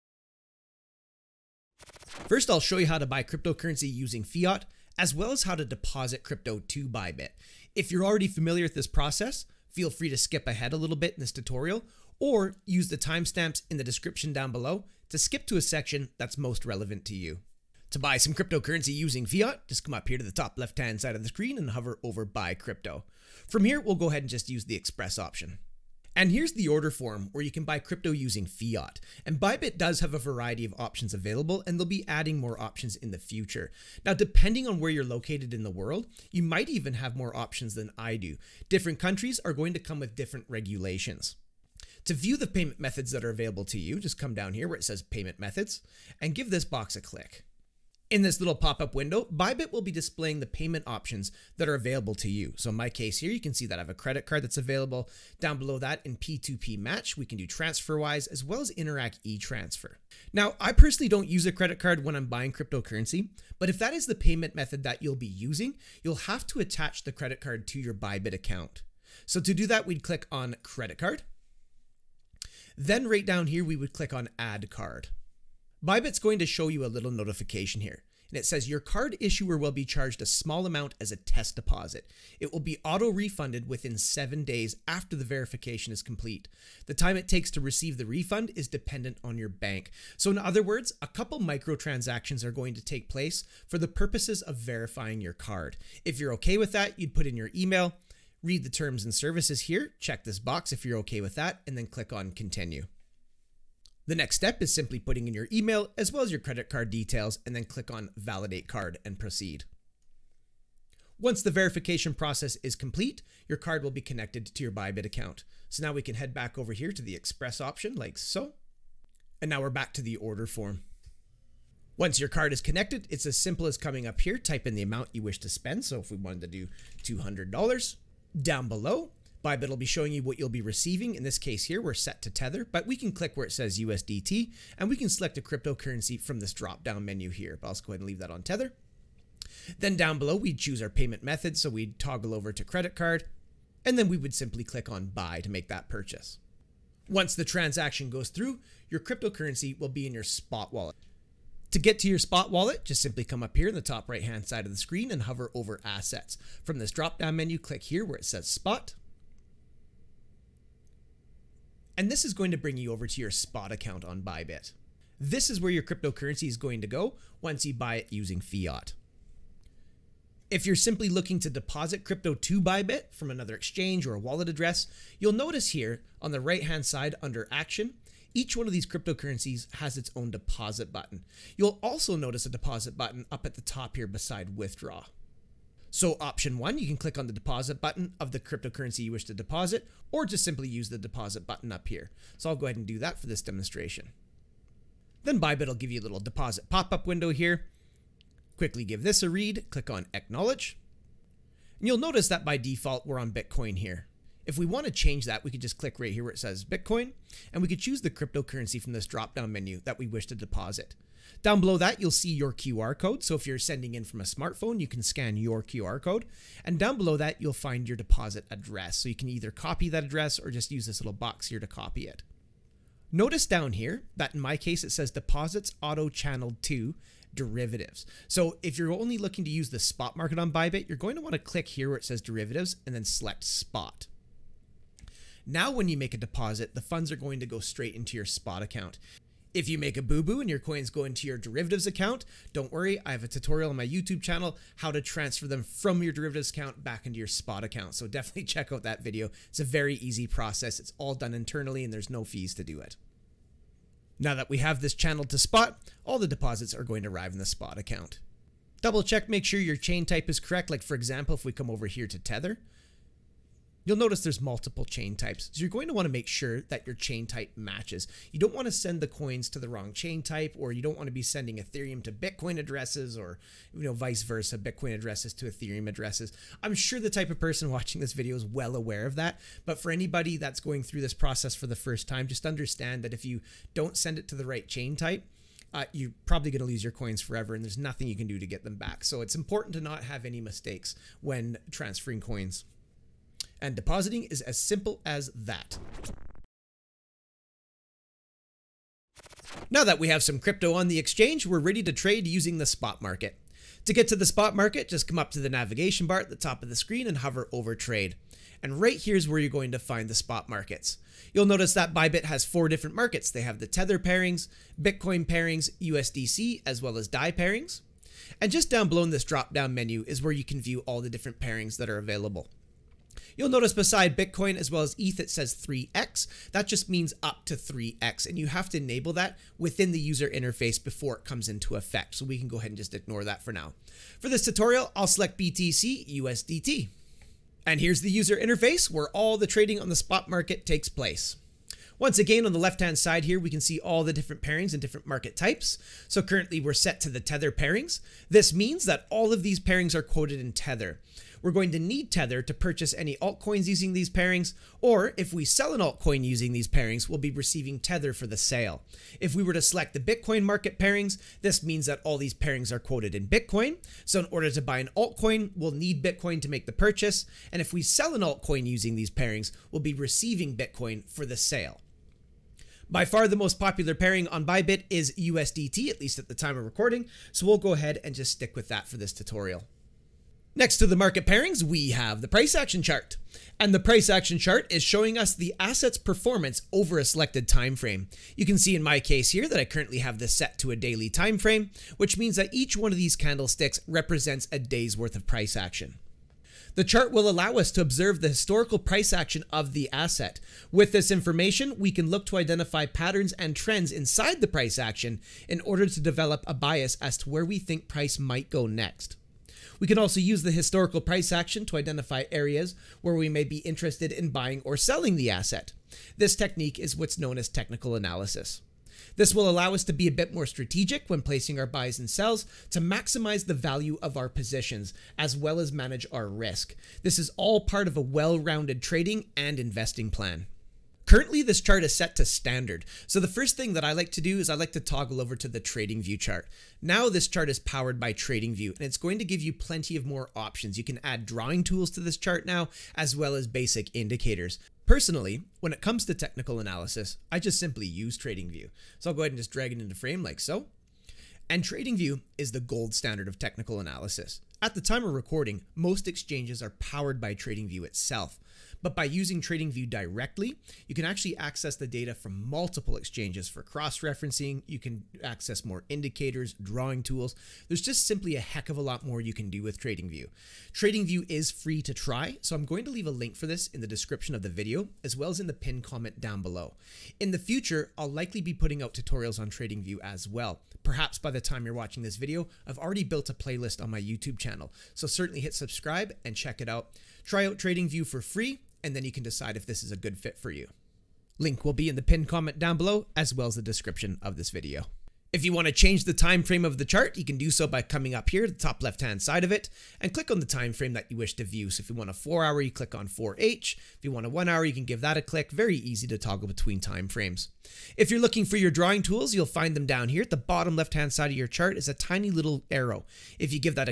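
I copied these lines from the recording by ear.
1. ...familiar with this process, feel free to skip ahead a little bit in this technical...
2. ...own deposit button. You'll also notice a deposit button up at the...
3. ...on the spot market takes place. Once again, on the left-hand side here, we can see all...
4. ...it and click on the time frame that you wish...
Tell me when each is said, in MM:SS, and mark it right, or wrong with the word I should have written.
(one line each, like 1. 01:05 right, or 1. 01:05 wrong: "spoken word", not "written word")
1. 00:08 wrong: "tutorial", not "technical"
2. 03:00 right
3. 05:39 right
4. 08:19 right.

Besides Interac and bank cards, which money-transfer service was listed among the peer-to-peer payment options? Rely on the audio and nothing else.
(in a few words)
TransferWise.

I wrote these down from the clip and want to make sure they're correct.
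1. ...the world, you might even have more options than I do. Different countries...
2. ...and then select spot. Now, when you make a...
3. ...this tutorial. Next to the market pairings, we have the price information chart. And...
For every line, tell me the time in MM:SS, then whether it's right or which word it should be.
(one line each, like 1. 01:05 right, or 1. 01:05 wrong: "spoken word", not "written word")
1. 00:35 right
2. 03:52 right
3. 06:18 wrong: "action", not "information".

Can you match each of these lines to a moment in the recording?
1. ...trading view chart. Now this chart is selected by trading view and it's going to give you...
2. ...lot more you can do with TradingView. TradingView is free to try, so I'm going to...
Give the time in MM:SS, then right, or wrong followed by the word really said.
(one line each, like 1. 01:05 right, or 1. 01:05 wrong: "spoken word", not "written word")
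1. 07:15 wrong: "powered", not "selected"
2. 07:48 right.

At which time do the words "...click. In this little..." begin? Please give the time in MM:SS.
00:47.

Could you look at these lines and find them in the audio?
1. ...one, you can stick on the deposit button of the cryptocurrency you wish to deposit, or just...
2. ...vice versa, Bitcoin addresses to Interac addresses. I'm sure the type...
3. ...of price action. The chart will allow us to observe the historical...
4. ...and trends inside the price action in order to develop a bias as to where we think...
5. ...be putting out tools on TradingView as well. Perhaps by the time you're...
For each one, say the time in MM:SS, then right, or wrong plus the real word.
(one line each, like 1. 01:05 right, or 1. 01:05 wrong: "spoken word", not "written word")
1. 03:06 wrong: "click", not "stick"
2. 04:33 wrong: "Ethereum", not "Interac"
3. 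06:35 right
4. 06:43 right
5. 07:58 wrong: "tutorials", not "tools".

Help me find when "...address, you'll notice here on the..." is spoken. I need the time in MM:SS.
02:54.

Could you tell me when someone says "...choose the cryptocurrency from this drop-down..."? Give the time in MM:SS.
03:27.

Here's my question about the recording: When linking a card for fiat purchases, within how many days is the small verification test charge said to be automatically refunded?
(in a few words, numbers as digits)
7 days.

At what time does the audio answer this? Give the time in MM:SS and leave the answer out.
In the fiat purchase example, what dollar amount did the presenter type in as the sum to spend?
02:07.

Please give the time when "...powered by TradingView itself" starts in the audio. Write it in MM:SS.
07:36.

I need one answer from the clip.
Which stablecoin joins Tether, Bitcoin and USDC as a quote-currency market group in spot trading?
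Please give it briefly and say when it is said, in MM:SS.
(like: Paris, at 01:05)
DAI, at 05:17.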